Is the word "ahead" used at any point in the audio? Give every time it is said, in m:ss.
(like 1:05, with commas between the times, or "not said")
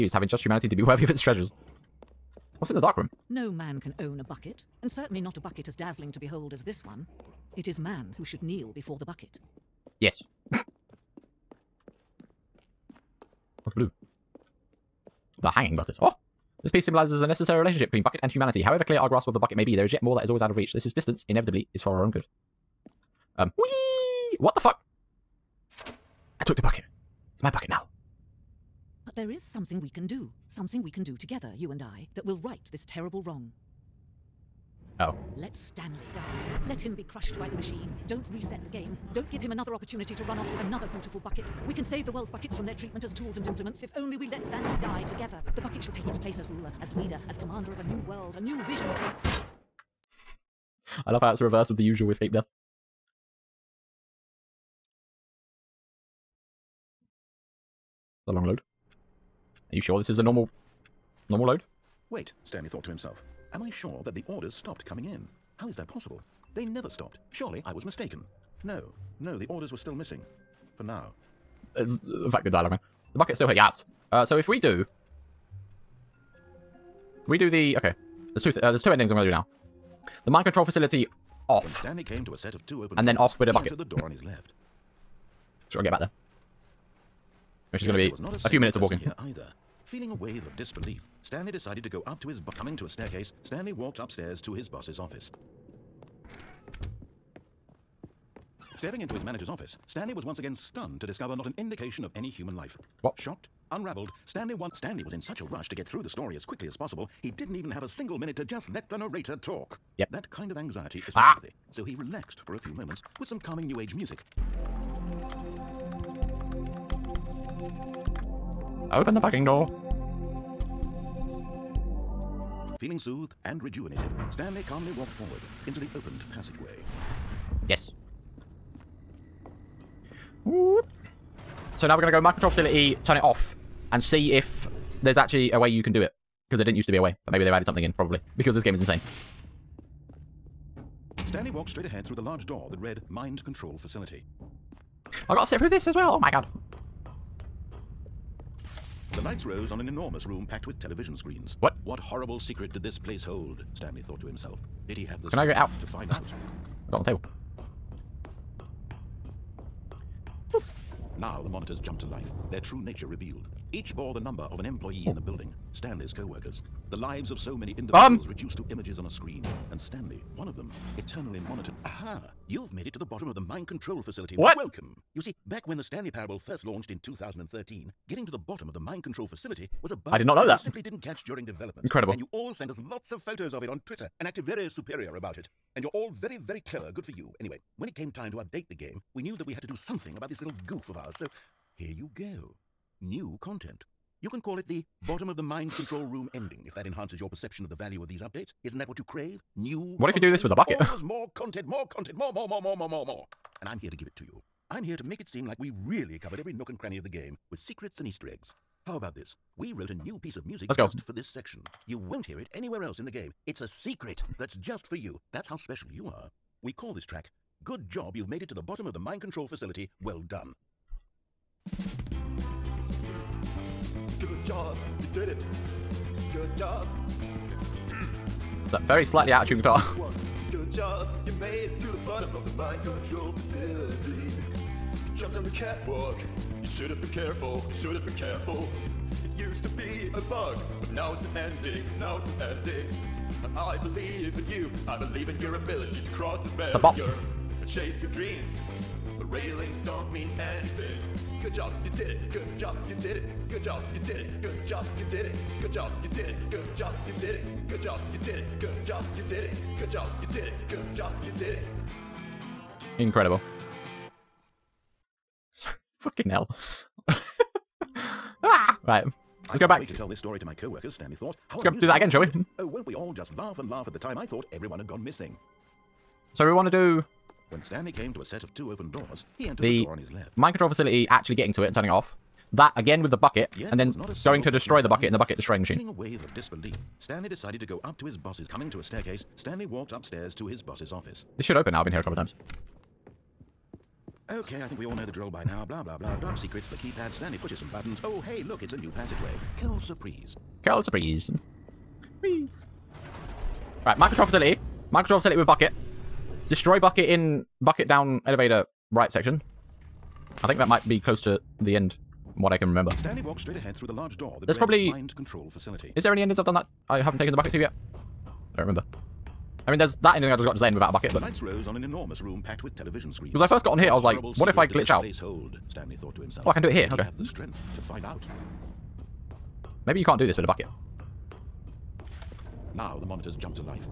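2:21, 5:13.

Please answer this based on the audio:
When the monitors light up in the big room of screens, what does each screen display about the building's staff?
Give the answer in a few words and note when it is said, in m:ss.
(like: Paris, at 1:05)
The number of an employee, at 2:44.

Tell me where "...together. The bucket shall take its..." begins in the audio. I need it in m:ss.
0:45.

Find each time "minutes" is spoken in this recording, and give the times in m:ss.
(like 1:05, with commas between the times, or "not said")
1:28, 1:48.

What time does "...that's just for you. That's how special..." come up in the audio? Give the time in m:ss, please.
3:34.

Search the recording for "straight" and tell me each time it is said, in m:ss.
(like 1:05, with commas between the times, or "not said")
2:21, 5:13.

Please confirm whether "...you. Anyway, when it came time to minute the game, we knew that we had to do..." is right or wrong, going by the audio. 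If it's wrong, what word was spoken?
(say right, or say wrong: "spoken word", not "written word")
wrong: "update", not "minute".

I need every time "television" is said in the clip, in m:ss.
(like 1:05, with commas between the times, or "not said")
2:30, 5:22.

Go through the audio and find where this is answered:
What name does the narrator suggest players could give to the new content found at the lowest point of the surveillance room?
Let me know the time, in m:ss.
3:14.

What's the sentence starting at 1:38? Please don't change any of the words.
Stepping into his manager's office, Stanley was once again stunned to discover not an indication of any human life.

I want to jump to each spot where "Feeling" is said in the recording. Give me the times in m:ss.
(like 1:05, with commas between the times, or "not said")
1:29, 2:02.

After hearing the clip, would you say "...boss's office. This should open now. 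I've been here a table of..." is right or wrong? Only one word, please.
wrong.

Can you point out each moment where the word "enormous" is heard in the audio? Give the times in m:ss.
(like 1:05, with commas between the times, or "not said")
2:29, 5:21.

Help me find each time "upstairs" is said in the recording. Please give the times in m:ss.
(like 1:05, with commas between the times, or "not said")
1:33, 4:49.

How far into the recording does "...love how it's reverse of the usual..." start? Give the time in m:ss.
0:51.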